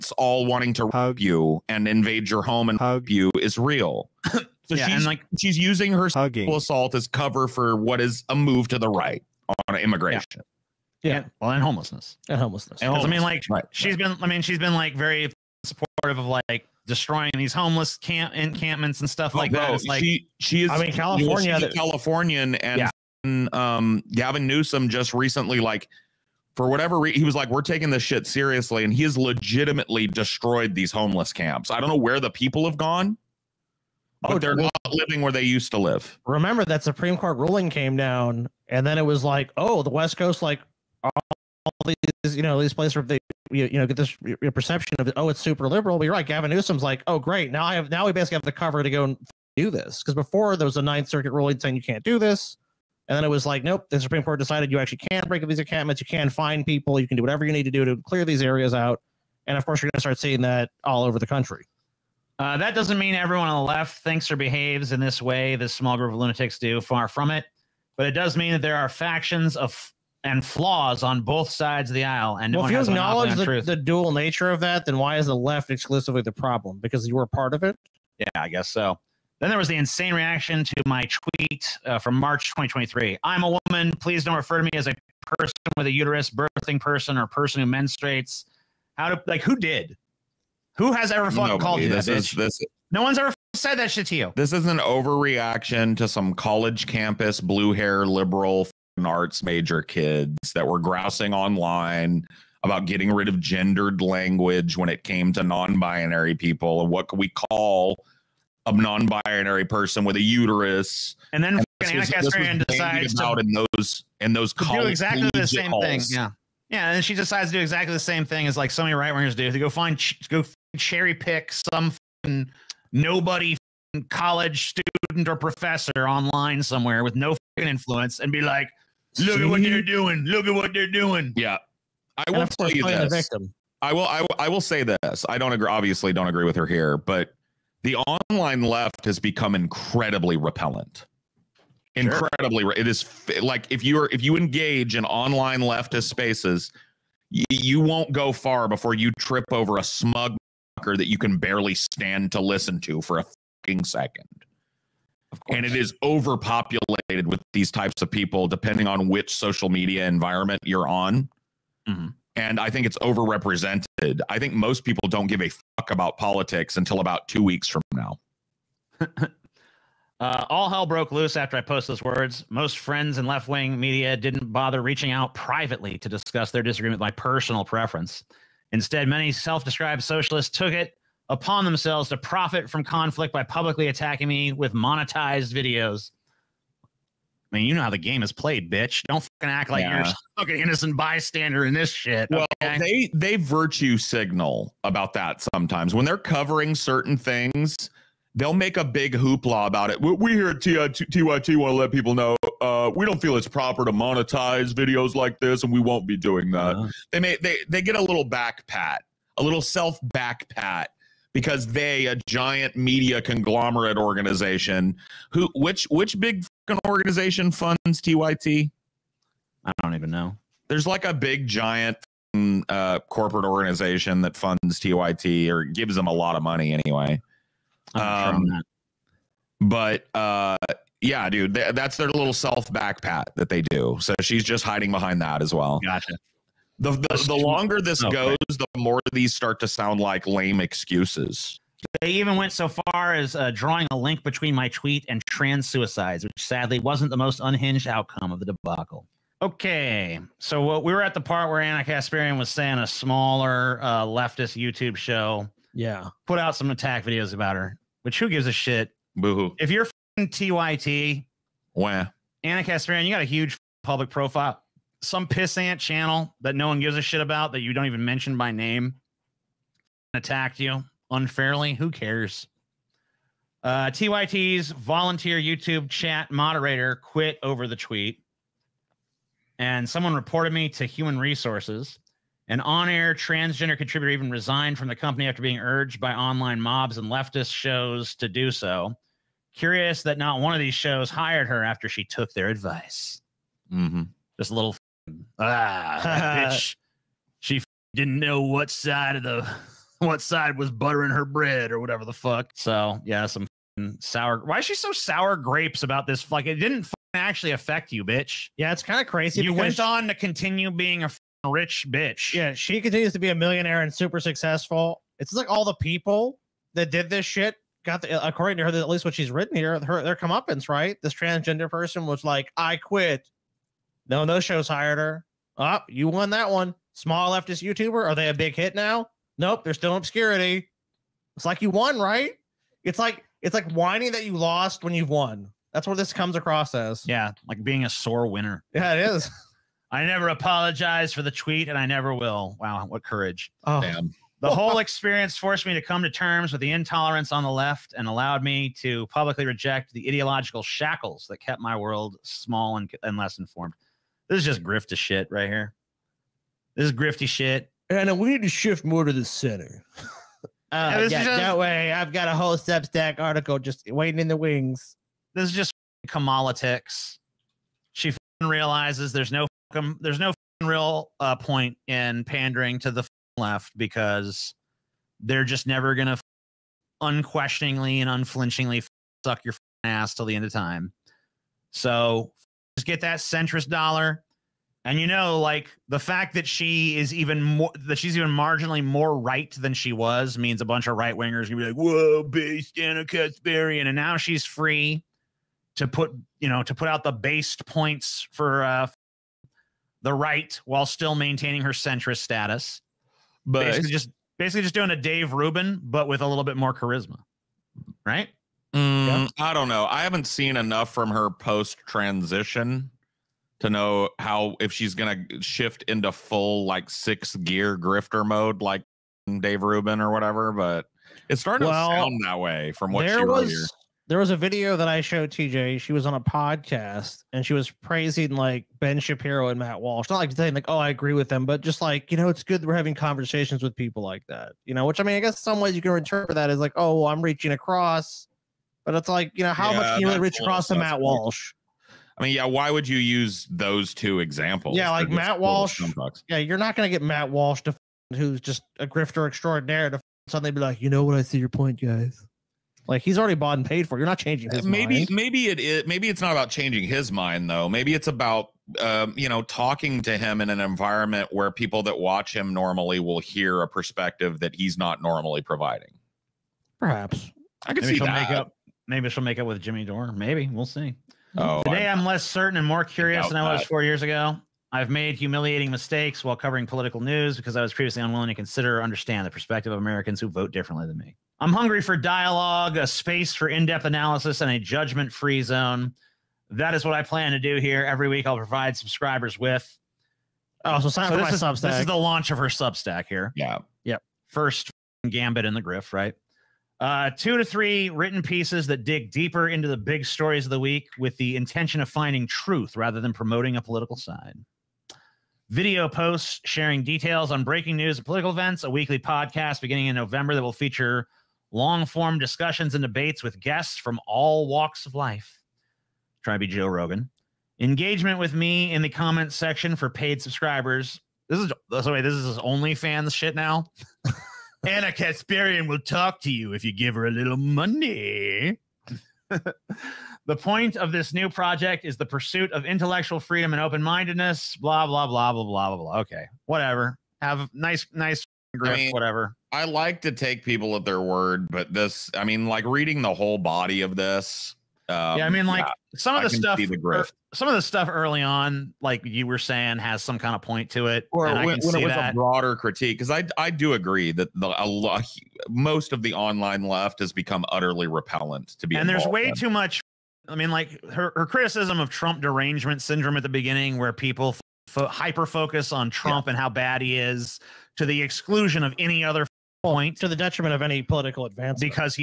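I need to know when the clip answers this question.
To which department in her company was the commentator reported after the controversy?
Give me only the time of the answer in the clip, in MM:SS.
04:40.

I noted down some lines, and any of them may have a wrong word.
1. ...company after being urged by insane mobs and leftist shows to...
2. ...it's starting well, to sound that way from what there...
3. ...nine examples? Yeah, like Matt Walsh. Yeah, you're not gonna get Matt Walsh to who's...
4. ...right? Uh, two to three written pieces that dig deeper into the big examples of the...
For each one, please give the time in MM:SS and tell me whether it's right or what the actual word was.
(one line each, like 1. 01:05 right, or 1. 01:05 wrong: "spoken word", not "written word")
1. 04:44 wrong: "online", not "insane"
2. 07:01 right
3. 07:23 wrong: "two", not "nine"
4. 08:15 wrong: "stories", not "examples".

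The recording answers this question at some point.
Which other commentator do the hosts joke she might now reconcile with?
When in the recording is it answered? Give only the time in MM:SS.
07:49.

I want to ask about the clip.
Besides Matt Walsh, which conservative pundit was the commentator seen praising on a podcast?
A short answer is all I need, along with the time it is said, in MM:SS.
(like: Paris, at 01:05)
Ben Shapiro, at 07:08.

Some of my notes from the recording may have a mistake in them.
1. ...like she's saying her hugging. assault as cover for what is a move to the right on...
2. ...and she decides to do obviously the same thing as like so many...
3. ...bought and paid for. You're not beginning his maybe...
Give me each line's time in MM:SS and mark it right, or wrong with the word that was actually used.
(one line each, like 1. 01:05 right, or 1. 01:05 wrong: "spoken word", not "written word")
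1. 00:05 wrong: "using", not "saying"
2. 01:56 wrong: "exactly", not "obviously"
3. 07:33 wrong: "changing", not "beginning".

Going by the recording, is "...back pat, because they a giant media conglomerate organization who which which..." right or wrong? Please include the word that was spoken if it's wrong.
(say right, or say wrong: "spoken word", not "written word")
right.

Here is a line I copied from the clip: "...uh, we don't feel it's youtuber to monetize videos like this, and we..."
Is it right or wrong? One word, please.
wrong.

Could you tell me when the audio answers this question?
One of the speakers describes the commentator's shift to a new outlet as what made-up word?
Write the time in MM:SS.
06:06.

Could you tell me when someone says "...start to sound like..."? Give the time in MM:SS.
03:59.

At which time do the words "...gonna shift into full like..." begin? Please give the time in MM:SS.
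06:54.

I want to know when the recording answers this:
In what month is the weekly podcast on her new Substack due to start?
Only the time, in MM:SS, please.
08:29.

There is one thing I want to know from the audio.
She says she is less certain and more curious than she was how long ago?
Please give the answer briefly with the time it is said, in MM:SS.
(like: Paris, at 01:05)
4 years ago, at 07:53.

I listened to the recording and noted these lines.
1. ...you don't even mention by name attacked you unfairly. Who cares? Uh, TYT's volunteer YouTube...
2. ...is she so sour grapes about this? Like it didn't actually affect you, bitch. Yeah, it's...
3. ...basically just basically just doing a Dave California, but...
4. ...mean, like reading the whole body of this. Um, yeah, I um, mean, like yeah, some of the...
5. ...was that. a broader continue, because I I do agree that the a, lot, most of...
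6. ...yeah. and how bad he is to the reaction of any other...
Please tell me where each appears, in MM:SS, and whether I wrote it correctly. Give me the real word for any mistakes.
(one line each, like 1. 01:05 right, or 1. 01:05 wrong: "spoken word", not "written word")
1. 04:27 right
2. 05:04 right
3. 06:43 wrong: "Rubin", not "California"
4. 09:02 right
5. 09:11 wrong: "critique", not "continue"
6. 09:26 wrong: "exclusion", not "reaction".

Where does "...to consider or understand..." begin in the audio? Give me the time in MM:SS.
07:58.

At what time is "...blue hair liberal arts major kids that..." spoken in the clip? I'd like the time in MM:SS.
01:37.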